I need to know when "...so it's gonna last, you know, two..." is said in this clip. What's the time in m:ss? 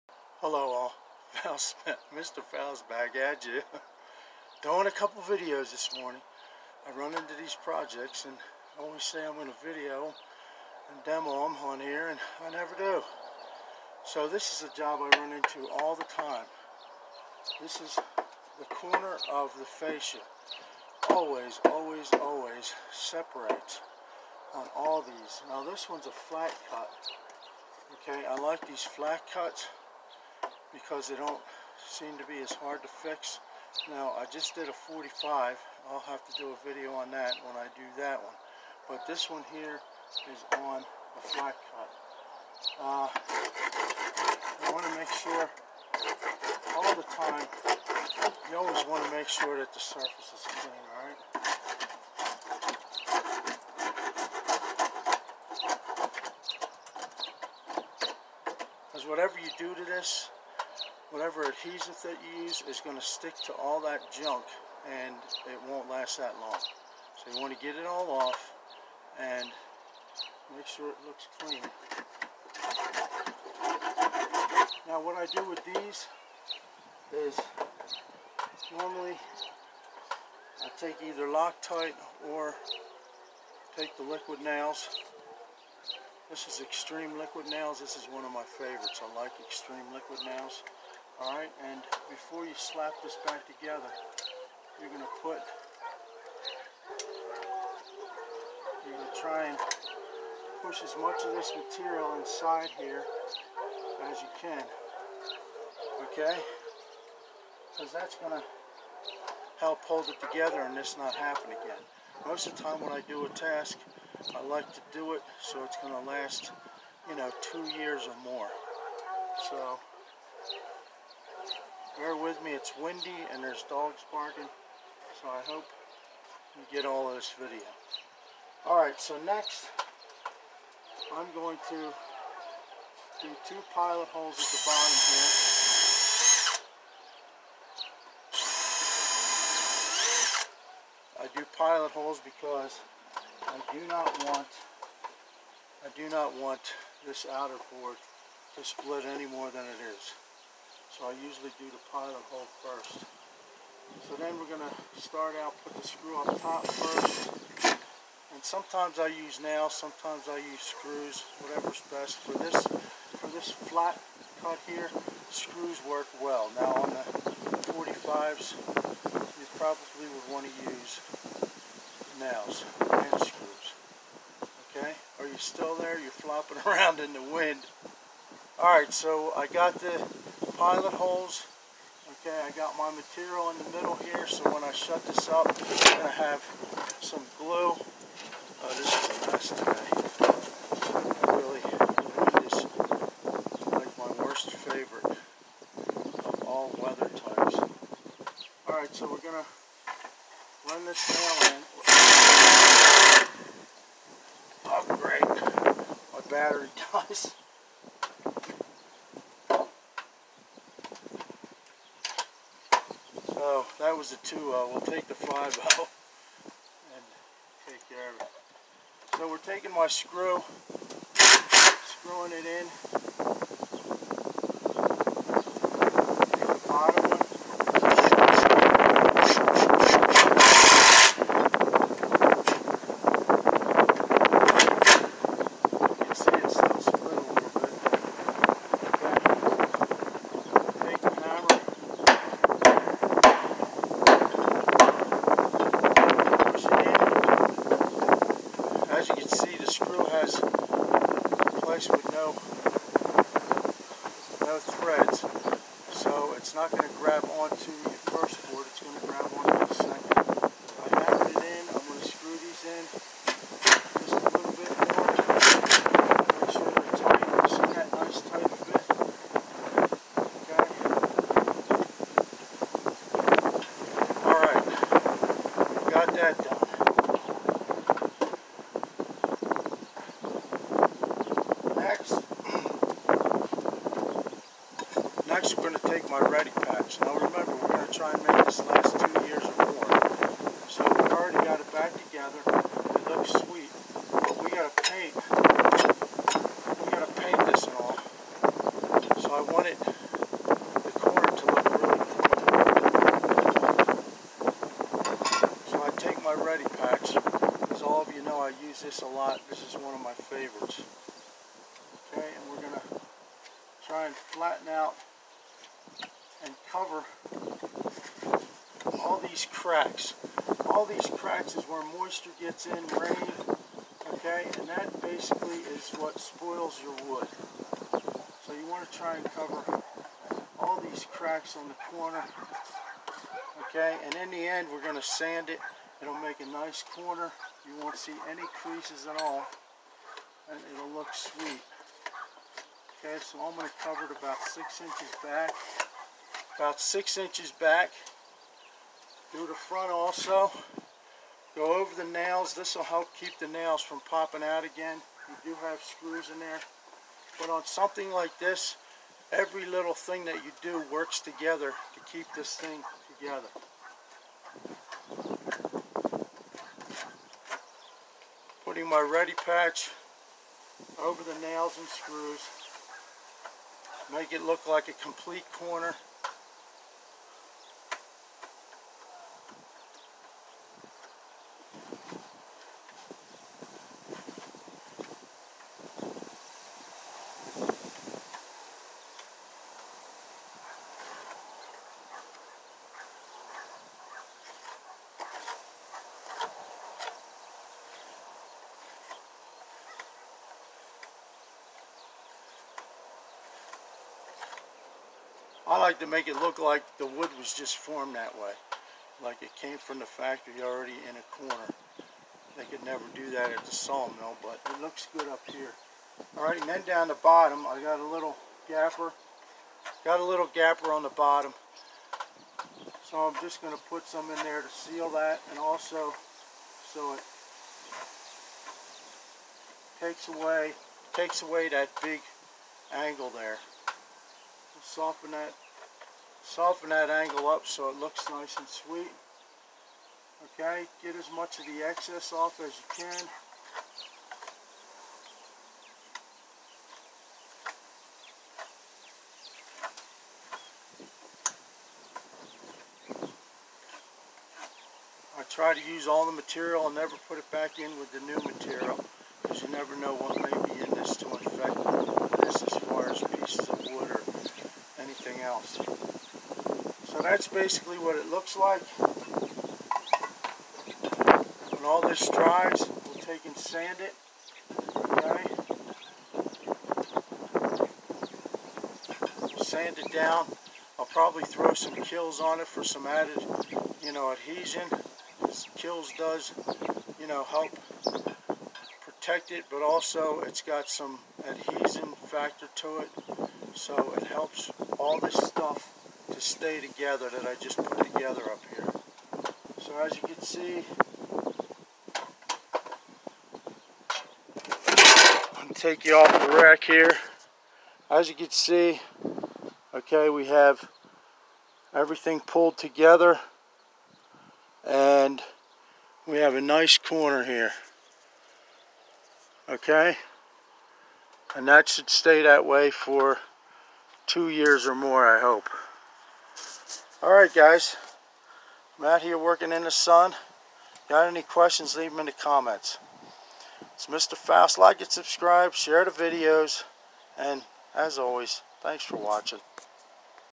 1:55.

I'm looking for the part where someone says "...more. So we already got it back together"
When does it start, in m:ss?
4:49.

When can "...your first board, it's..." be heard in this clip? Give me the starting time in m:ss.
4:17.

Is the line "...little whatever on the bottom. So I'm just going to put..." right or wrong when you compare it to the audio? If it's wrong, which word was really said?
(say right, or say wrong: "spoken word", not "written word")
wrong: "gapper", not "whatever".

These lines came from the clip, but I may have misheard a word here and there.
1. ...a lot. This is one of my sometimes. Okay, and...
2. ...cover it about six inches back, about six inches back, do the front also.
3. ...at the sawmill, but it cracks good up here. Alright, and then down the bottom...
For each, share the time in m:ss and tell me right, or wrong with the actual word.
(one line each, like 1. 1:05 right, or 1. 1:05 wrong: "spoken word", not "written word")
1. 5:09 wrong: "favorites", not "sometimes"
2. 5:43 right
3. 6:53 wrong: "looks", not "cracks".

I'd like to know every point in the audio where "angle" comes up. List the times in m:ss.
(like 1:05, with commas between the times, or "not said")
7:12, 7:17.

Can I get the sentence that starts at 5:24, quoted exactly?
And that basically is what spoils your wood.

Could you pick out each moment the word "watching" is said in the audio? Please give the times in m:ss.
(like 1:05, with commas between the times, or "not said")
8:59.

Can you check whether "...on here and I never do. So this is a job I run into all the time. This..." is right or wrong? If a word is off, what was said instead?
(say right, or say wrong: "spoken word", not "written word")
right.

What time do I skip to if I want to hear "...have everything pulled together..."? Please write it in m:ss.
8:30.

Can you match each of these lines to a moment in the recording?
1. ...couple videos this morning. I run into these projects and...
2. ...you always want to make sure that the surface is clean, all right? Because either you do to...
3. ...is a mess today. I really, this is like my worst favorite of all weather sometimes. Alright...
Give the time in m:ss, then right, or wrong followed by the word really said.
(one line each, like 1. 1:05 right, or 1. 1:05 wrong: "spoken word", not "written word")
1. 0:04 right
2. 0:48 wrong: "whatever", not "either"
3. 3:08 wrong: "types", not "sometimes".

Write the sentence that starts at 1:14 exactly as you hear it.
Now what I do with these is normally I take either Loctite or take the liquid nails.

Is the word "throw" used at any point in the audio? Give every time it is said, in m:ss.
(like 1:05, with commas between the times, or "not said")
8:01.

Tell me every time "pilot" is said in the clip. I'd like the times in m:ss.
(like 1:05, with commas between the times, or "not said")
2:13, 2:21, 2:31, 3:00.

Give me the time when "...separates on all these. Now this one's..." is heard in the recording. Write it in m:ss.
0:22.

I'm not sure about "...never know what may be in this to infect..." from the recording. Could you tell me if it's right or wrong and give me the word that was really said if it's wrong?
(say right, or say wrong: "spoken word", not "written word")
right.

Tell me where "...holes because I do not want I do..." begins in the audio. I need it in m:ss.
2:21.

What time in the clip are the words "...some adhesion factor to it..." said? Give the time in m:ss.
8:10.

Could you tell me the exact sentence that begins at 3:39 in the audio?
So we're taking my screw, screwing it in.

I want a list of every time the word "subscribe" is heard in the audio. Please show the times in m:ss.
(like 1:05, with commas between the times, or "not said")
8:55.